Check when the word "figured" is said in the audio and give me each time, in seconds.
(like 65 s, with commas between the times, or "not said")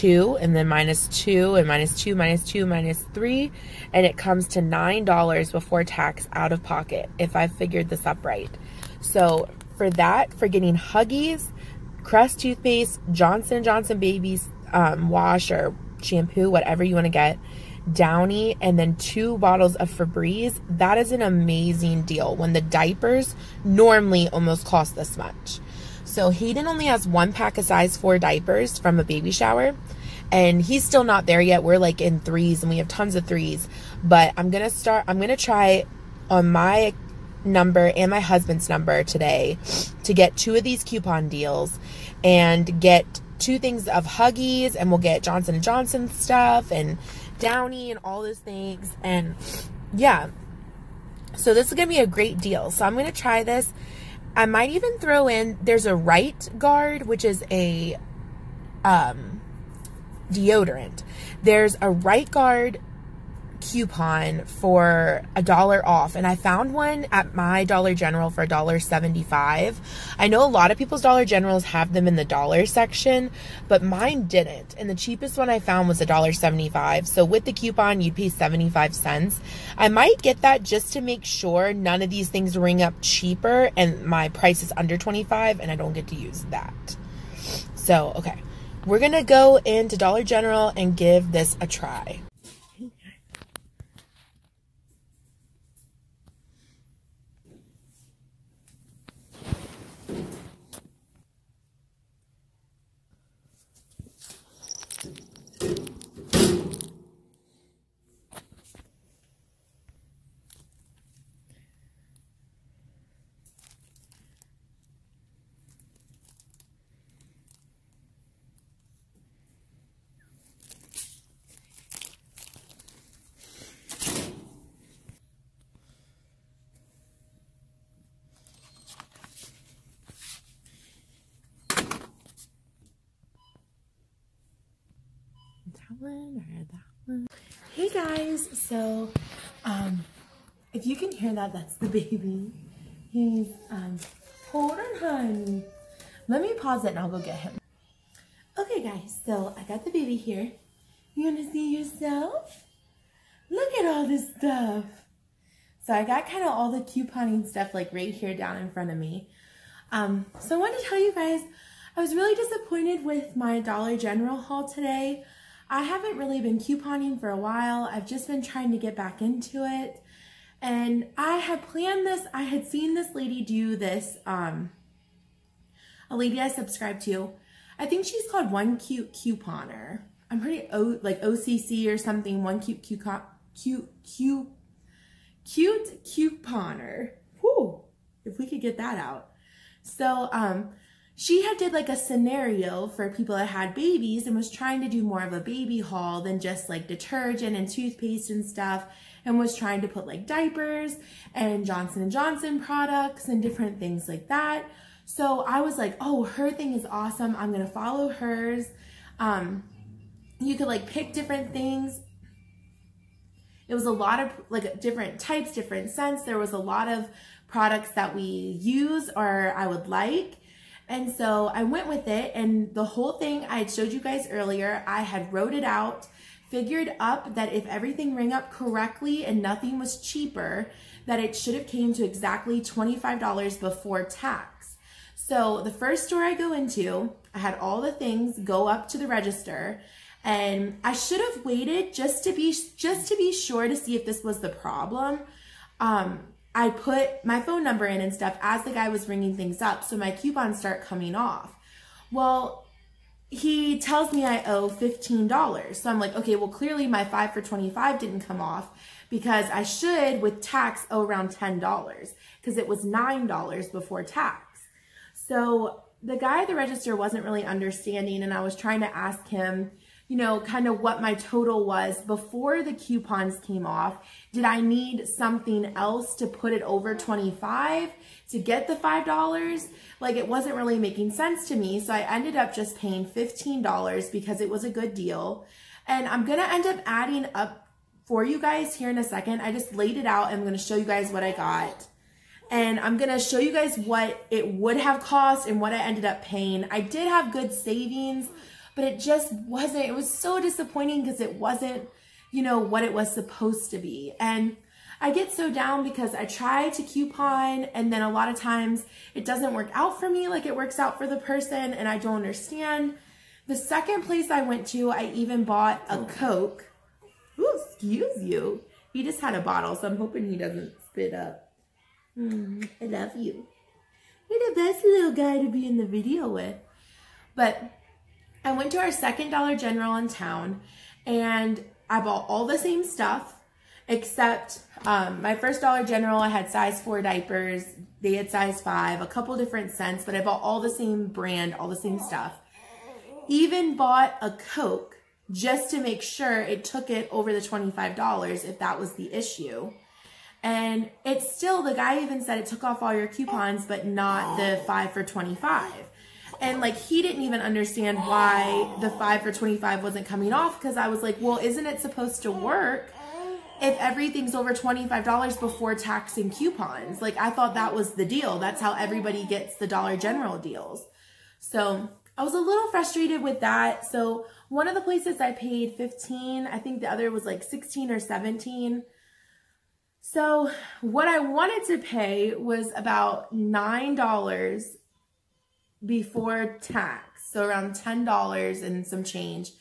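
7 s, 226 s.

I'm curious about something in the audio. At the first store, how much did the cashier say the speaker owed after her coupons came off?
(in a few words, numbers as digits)
$15.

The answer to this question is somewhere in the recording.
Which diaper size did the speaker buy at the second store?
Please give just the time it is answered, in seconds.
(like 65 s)
338 s.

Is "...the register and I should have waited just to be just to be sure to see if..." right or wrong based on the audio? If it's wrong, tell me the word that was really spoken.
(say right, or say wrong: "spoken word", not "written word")
right.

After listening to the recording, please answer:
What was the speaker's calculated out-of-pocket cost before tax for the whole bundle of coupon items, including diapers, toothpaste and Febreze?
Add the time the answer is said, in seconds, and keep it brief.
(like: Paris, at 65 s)
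$9, at 4 s.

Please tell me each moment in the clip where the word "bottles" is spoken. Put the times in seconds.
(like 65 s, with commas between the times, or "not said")
19 s, 319 s.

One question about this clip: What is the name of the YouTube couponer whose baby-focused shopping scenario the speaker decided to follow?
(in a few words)
One Cute Couponer.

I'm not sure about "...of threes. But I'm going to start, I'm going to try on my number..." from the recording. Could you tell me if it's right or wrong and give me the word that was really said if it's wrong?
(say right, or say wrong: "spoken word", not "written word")
right.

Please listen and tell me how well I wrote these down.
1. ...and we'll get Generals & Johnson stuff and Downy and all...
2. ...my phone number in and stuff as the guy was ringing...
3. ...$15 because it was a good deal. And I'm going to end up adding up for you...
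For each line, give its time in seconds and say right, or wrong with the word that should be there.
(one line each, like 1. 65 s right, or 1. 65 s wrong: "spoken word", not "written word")
1. 44 s wrong: "Johnson", not "Generals"
2. 247 s right
3. 283 s right.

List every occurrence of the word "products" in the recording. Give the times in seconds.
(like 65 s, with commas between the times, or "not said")
202 s, 217 s.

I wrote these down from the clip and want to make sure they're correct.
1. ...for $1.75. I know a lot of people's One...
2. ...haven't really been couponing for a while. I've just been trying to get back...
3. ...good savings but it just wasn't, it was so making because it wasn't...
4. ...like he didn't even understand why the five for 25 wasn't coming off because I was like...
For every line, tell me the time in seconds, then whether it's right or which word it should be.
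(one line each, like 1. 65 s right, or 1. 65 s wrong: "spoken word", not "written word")
1. 68 s wrong: "Dollar", not "One"
2. 165 s right
3. 297 s wrong: "disappointing", not "making"
4. 356 s right.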